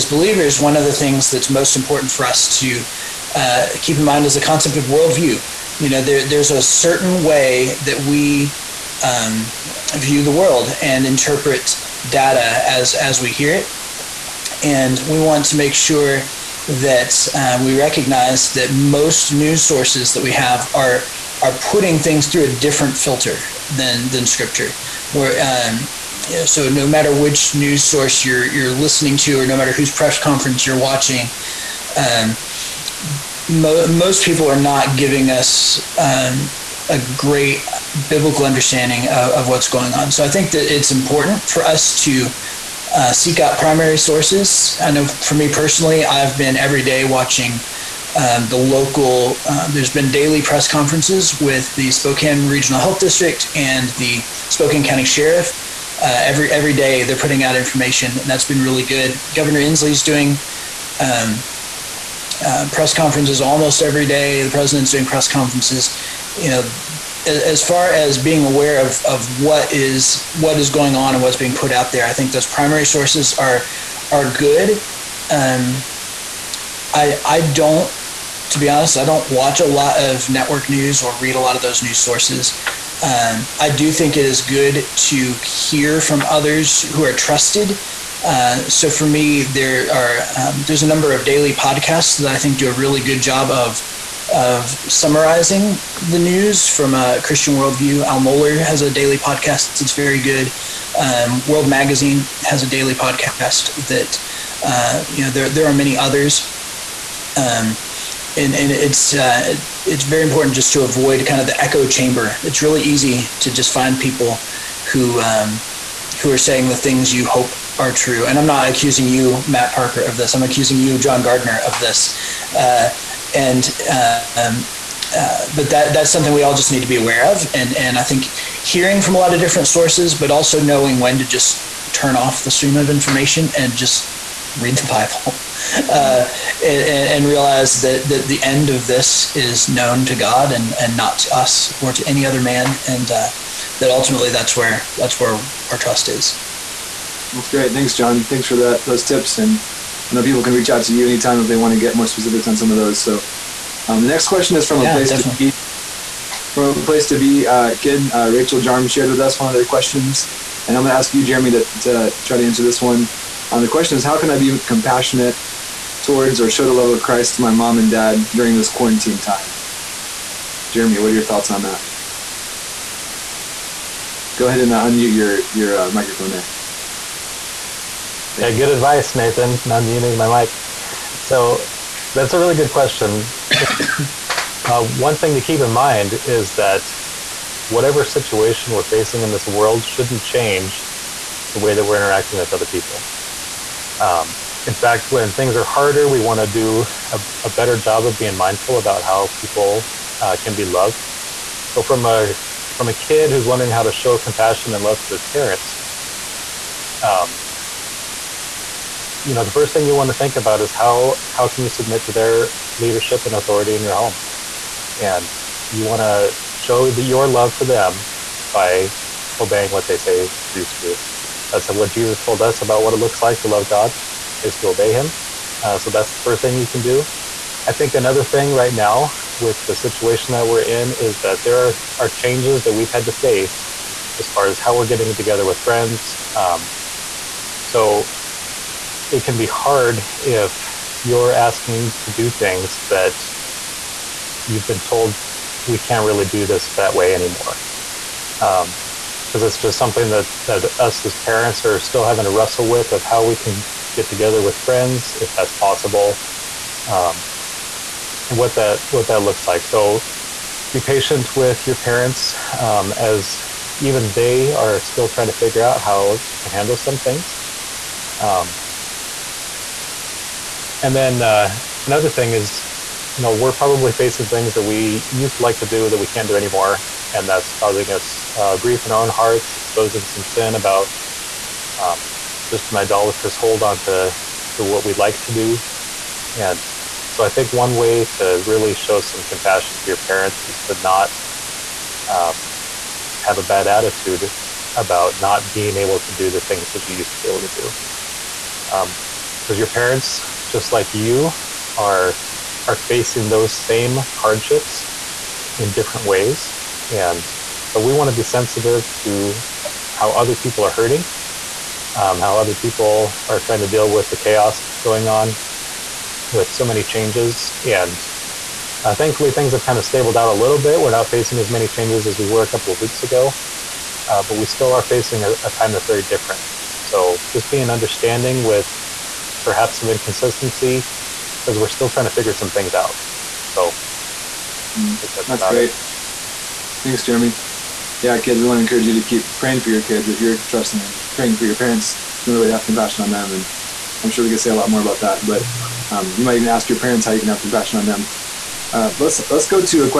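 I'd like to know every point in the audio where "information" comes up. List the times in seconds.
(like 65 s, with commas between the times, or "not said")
57 s, 132 s.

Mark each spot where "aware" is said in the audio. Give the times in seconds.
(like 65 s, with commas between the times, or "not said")
68 s, 126 s.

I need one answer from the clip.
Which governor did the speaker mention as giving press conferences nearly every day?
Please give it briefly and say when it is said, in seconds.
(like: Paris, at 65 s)
Governor Inslee, at 59 s.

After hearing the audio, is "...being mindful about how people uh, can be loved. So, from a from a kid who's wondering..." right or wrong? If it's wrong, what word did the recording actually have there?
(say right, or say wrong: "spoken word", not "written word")
right.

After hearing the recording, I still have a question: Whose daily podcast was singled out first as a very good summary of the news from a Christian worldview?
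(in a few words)
Al Mohler.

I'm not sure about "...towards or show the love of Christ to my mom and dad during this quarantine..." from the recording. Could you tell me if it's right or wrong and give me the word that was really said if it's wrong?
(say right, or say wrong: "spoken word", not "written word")
right.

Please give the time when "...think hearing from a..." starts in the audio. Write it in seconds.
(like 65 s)
128 s.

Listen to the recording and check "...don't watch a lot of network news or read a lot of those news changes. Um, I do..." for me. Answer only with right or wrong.
wrong.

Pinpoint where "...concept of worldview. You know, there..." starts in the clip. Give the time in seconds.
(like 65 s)
4 s.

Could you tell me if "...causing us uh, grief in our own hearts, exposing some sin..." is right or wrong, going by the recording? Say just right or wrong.
right.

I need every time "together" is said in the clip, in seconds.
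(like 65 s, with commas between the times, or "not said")
235 s, 254 s.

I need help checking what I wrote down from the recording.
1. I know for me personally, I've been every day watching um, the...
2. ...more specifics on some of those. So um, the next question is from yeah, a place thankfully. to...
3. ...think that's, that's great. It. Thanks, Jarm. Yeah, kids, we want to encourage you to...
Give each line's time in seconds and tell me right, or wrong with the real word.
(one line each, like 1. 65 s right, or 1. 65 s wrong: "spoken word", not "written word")
1. 44 s right
2. 151 s wrong: "definitely", not "thankfully"
3. 334 s wrong: "Jeremy", not "Jarm".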